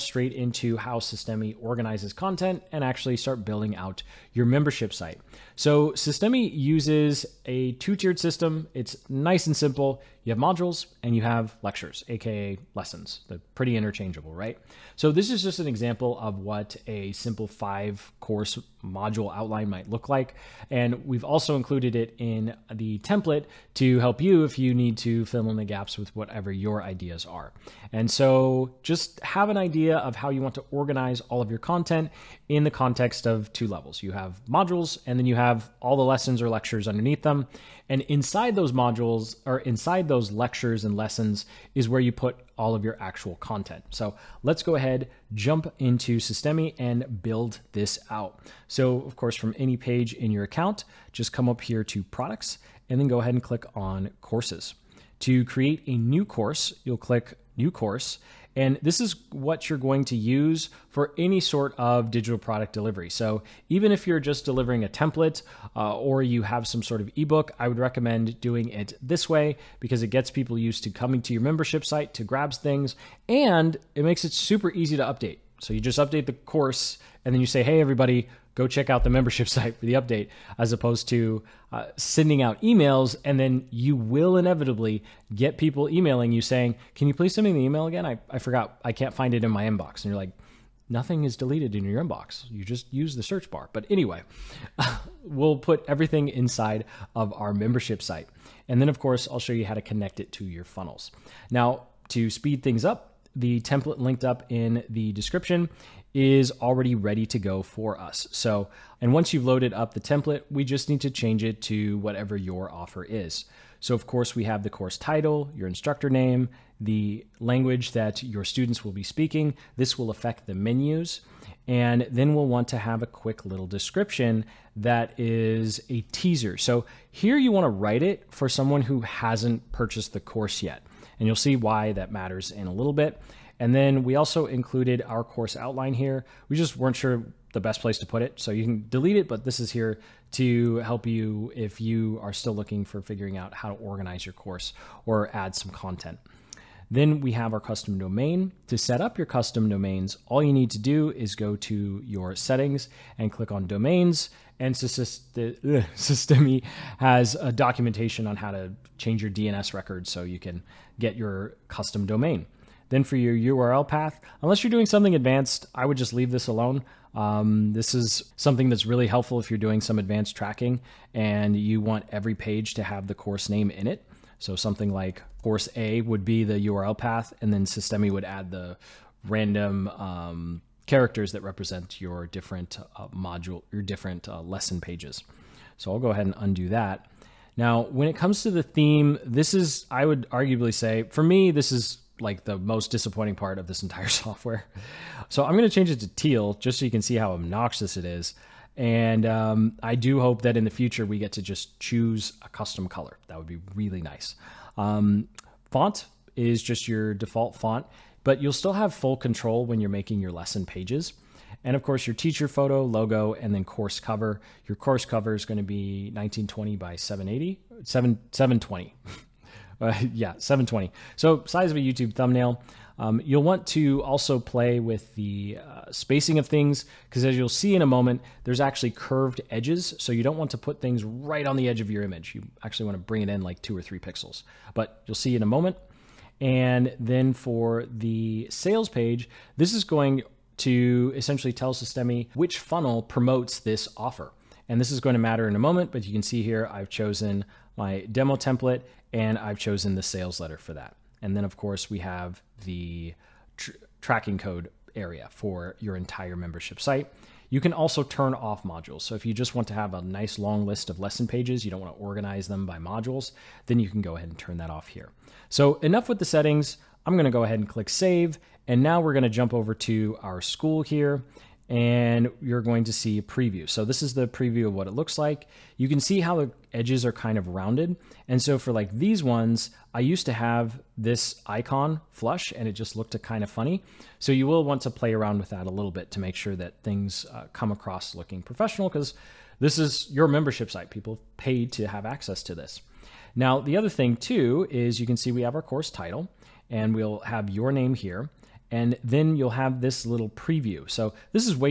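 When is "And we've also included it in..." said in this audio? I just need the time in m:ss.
0:20.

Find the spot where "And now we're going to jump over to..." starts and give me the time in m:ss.
4:28.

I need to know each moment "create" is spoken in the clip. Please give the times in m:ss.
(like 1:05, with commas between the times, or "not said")
0:55.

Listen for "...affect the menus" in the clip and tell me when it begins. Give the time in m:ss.
2:00.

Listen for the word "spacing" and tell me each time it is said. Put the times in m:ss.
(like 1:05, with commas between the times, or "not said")
3:45.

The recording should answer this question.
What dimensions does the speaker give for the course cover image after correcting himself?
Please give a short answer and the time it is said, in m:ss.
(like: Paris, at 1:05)
1920 by 720, at 3:36.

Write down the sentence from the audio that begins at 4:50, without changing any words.
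People paid to have access to this.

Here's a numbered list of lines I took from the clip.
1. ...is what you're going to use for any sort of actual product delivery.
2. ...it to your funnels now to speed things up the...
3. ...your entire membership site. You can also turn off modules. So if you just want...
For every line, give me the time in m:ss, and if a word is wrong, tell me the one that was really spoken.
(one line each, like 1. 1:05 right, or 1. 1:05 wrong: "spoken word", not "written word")
1. 0:59 wrong: "digital", not "actual"
2. 1:40 right
3. 4:15 right.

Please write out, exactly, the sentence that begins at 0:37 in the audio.
And inside those modules or inside those lectures and lessons is where you put all of your actual content.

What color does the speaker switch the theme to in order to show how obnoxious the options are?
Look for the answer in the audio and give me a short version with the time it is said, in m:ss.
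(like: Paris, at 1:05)
Teal, at 3:16.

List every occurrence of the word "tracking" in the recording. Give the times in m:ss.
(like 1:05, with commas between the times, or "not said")
2:50, 4:14.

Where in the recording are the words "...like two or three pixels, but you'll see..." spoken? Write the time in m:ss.
3:53.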